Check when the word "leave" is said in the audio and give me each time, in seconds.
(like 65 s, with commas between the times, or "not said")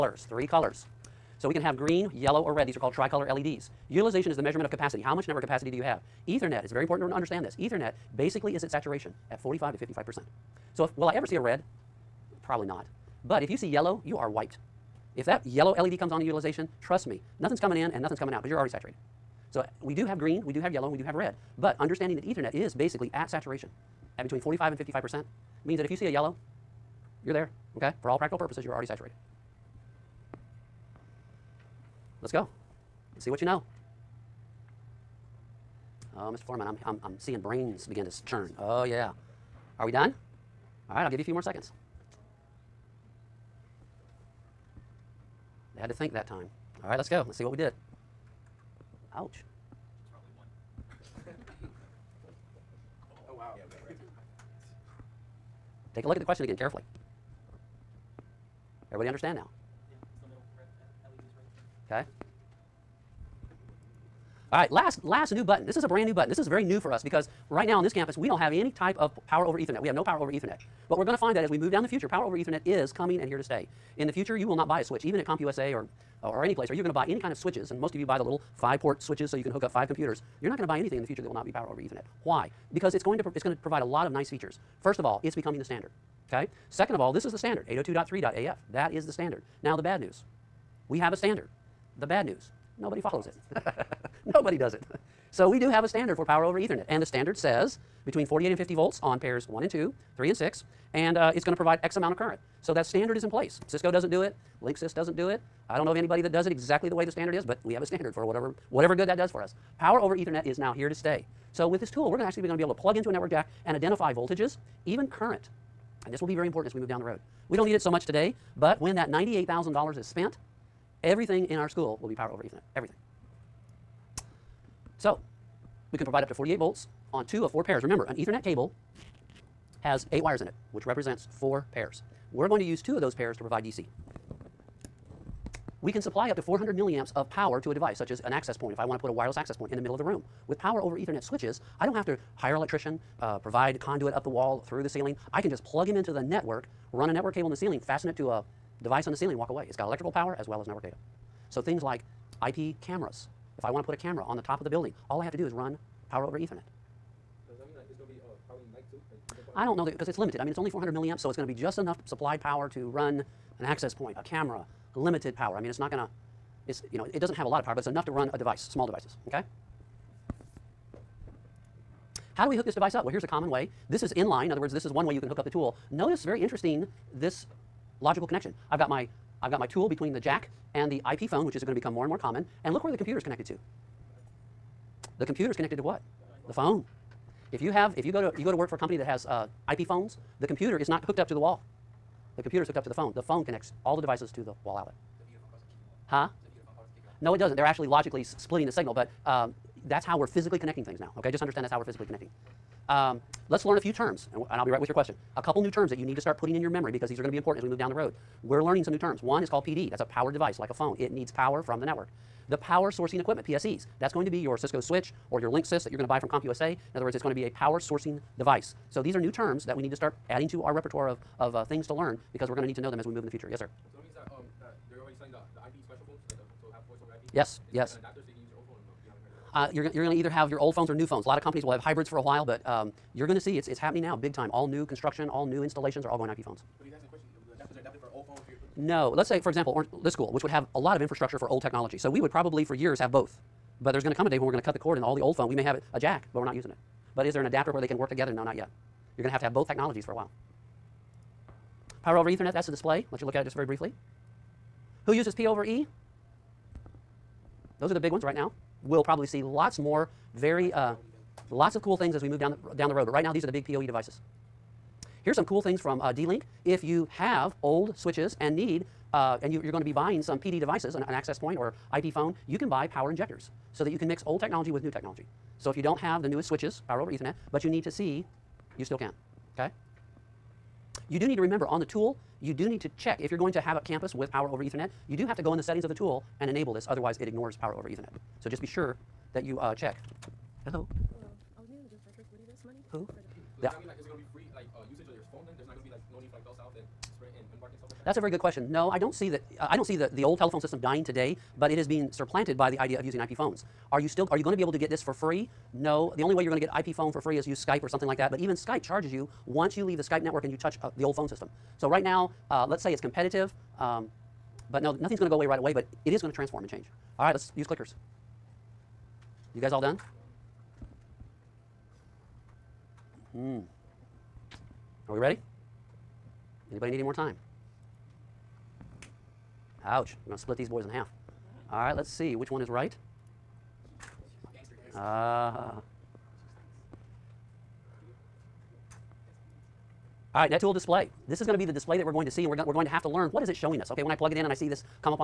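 309 s.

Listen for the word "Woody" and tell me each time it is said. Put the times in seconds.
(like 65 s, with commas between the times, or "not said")
292 s.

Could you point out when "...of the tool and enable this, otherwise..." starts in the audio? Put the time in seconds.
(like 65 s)
285 s.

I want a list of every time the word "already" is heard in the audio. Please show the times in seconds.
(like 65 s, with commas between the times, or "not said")
18 s, 28 s, 225 s.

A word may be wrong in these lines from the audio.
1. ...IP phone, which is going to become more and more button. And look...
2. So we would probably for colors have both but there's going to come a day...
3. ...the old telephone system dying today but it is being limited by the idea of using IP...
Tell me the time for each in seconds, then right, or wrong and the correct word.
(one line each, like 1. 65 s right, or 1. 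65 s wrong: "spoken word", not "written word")
1. 181 s wrong: "common", not "button"
2. 241 s wrong: "years", not "colors"
3. 300 s wrong: "supplanted", not "limited".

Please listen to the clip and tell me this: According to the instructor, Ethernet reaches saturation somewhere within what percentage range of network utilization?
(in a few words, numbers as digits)
45 to 55%.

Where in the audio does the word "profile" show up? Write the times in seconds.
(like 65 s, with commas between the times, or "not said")
not said.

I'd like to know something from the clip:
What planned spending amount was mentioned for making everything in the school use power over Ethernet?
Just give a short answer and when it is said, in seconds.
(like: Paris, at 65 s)
$98,000, at 119 s.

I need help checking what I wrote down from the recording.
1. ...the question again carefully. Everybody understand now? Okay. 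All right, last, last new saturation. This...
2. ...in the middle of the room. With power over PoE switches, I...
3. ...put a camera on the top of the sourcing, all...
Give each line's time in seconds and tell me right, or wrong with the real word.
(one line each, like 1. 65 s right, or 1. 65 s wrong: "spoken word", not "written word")
1. 56 s wrong: "button", not "saturation"
2. 139 s wrong: "Ethernet", not "PoE"
3. 153 s wrong: "building", not "sourcing".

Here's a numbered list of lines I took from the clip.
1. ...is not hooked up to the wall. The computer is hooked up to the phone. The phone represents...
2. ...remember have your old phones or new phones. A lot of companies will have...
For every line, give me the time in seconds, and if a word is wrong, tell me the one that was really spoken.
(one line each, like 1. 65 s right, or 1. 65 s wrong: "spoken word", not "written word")
1. 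190 s wrong: "connects", not "represents"
2. 230 s wrong: "either", not "remember".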